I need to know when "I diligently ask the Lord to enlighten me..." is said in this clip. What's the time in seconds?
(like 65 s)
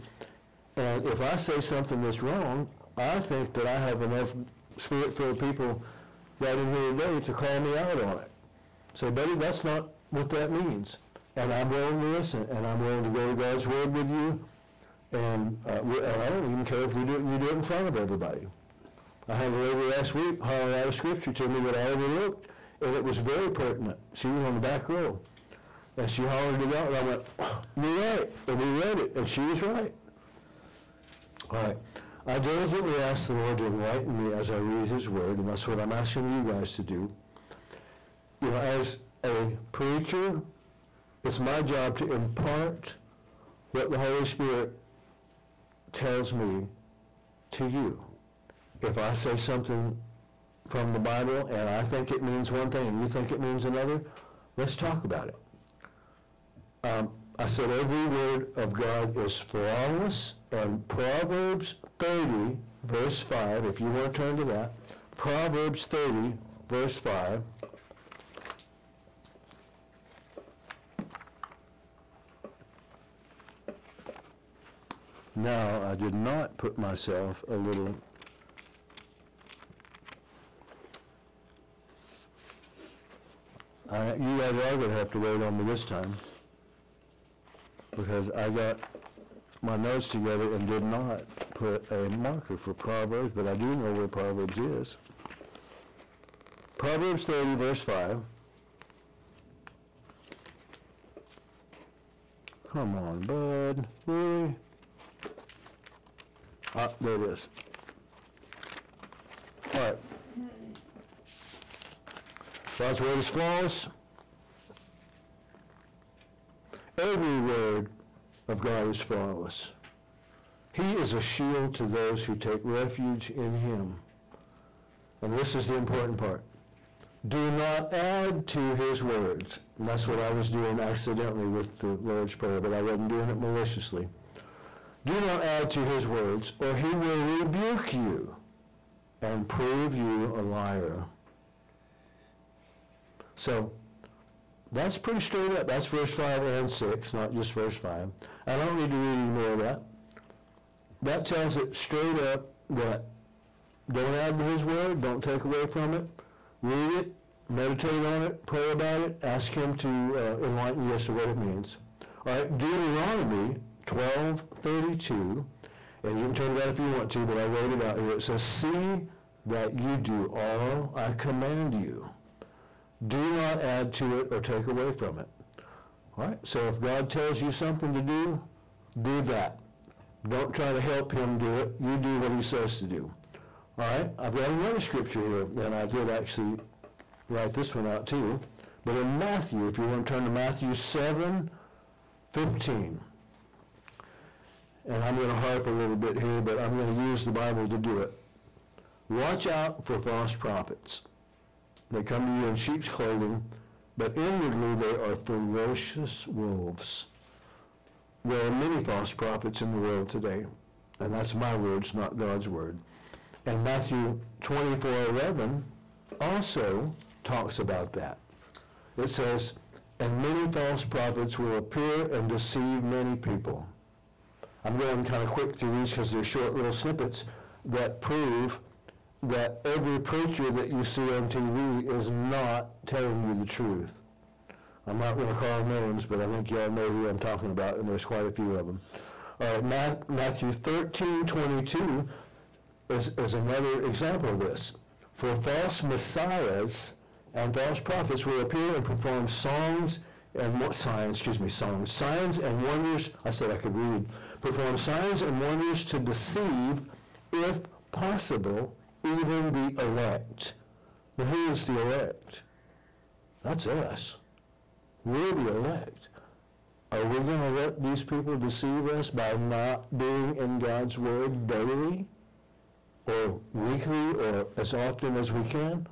32 s.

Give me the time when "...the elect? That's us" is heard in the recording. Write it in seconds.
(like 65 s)
261 s.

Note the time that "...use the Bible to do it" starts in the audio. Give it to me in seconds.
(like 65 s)
196 s.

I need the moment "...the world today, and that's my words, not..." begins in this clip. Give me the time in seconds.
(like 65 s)
209 s.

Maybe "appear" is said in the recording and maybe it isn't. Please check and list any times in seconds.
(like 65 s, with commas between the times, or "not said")
221 s, 248 s.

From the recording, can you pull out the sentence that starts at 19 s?
I had a lady last week holler out a scripture to me that I overlooked, and it was very pertinent.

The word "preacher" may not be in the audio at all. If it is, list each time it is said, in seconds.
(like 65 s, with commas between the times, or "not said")
39 s, 229 s.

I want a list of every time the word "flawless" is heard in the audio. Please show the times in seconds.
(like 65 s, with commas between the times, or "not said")
59 s, 113 s, 119 s.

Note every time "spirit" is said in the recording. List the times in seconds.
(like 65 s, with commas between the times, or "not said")
4 s, 44 s.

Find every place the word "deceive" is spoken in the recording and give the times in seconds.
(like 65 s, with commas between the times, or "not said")
222 s, 255 s, 268 s.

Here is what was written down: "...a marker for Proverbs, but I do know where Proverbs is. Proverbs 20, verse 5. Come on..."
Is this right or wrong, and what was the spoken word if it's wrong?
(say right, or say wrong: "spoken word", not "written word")
wrong: "30", not "20".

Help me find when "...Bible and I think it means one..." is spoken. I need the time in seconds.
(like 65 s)
50 s.